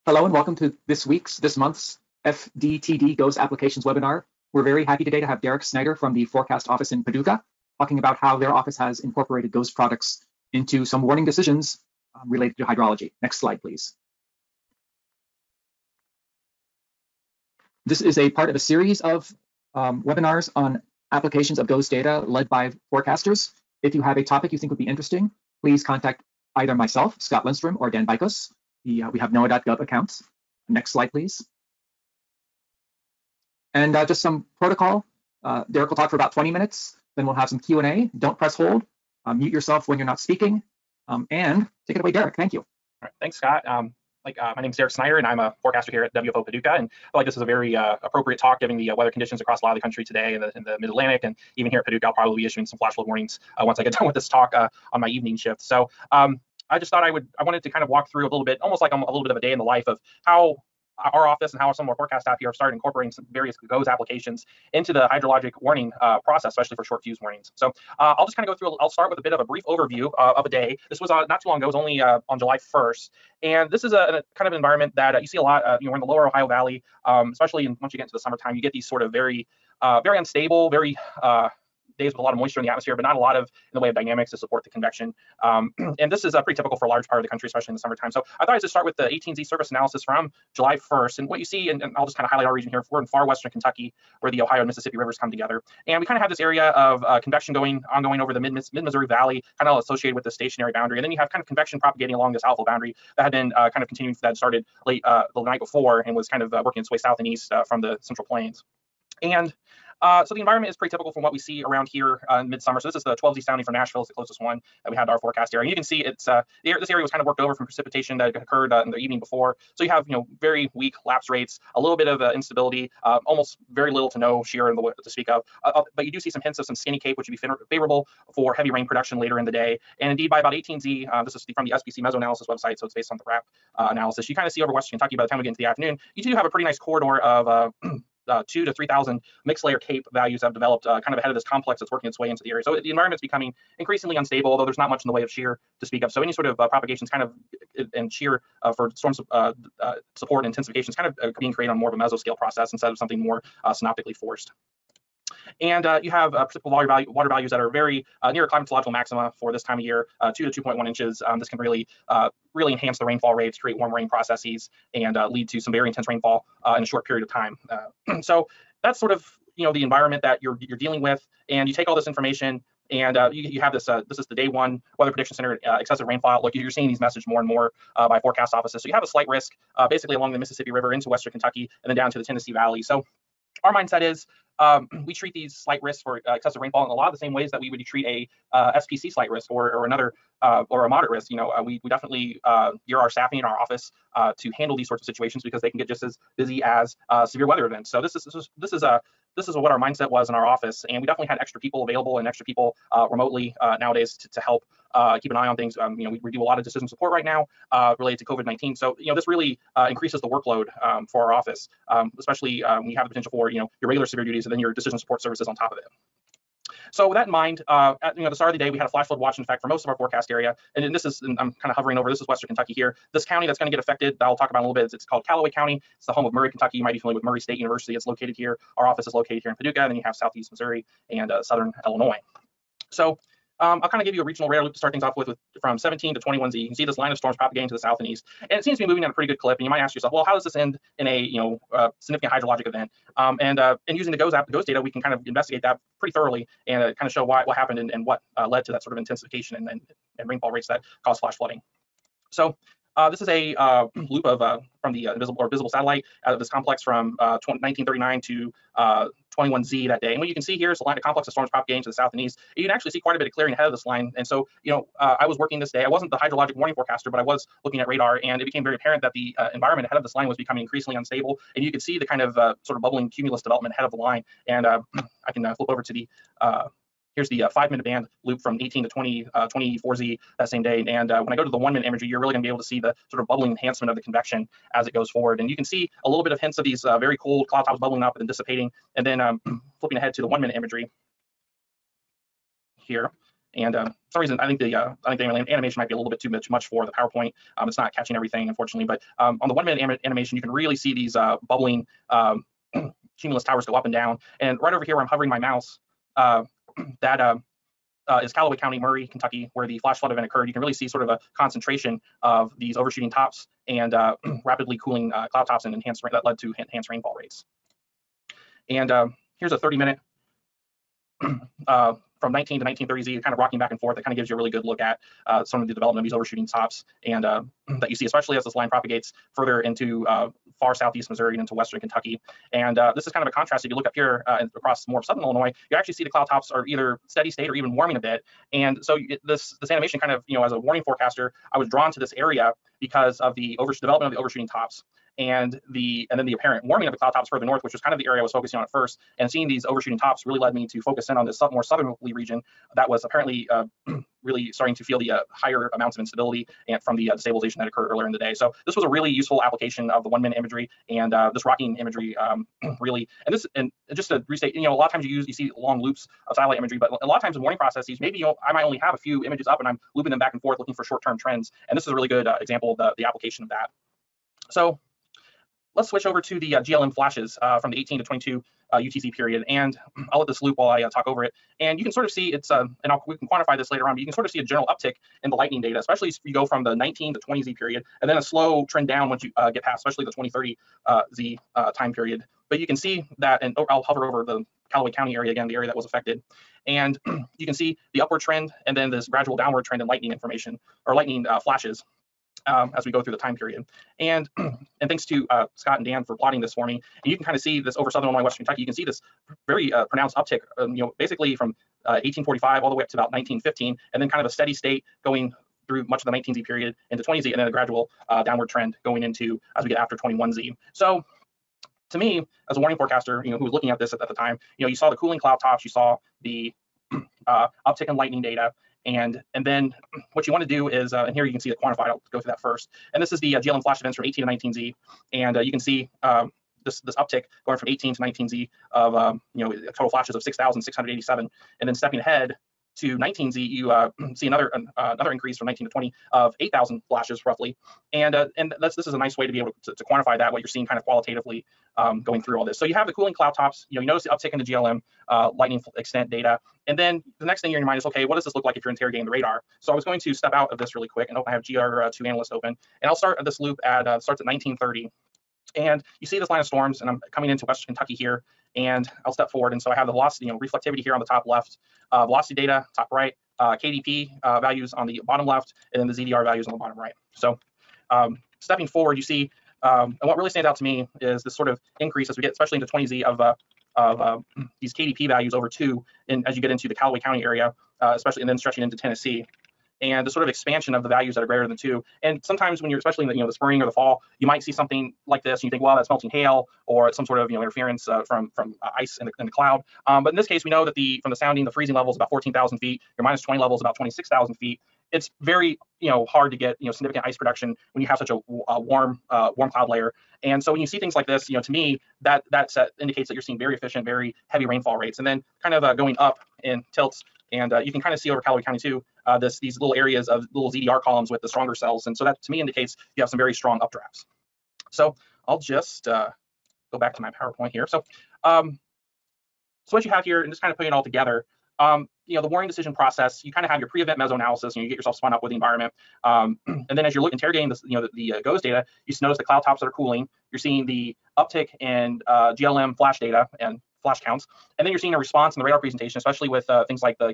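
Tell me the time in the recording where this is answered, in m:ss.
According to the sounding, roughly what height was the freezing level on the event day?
8:22.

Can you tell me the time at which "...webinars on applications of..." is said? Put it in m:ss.
0:20.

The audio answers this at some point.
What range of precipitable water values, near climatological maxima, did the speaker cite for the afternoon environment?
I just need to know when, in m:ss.
2:40.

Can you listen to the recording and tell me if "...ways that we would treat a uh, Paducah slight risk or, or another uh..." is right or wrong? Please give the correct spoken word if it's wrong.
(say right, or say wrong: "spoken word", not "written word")
wrong: "SPC", not "Paducah".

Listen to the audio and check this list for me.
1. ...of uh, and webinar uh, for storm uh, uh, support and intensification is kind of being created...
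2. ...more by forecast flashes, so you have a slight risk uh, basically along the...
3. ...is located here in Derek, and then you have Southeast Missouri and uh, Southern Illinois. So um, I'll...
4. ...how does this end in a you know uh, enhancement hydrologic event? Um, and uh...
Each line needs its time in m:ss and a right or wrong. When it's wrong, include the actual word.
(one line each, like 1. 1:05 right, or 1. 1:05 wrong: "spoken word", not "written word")
1. 2:27 wrong: "shear", not "webinar"
2. 2:57 wrong: "offices", not "flashes"
3. 3:49 wrong: "Paducah", not "Derek"
4. 4:00 wrong: "significant", not "enhancement".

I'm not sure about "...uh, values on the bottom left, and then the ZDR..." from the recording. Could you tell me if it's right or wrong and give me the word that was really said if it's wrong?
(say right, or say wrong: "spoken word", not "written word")
right.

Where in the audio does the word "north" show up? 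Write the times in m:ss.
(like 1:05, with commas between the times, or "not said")
5:47.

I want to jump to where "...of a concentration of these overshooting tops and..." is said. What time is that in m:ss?
5:11.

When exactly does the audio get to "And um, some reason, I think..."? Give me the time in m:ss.
4:53.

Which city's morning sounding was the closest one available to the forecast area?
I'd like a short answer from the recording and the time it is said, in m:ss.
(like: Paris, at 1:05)
Nashville, at 1:53.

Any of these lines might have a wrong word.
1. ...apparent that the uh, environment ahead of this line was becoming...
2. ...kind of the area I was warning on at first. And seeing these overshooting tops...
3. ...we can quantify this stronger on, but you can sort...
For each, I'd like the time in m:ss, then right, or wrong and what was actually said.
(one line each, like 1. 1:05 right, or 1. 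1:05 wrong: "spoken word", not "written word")
1. 4:28 right
2. 5:47 wrong: "focusing", not "warning"
3. 6:23 wrong: "later", not "stronger".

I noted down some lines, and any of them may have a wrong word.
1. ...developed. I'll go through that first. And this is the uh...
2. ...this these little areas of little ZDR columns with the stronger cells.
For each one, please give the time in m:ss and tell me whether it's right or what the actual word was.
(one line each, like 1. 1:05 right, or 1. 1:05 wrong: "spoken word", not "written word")
1. 7:11 wrong: "quantified", not "developed"
2. 8:39 right.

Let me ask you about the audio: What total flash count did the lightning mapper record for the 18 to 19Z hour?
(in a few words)
6,687.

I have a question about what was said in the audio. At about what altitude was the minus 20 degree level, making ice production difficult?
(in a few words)
26,000 feet.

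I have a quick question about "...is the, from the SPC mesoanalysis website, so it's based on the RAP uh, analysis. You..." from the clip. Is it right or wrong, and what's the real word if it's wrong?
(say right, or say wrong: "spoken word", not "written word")
right.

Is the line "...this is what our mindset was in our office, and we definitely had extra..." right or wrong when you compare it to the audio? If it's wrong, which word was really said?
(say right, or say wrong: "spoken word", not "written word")
right.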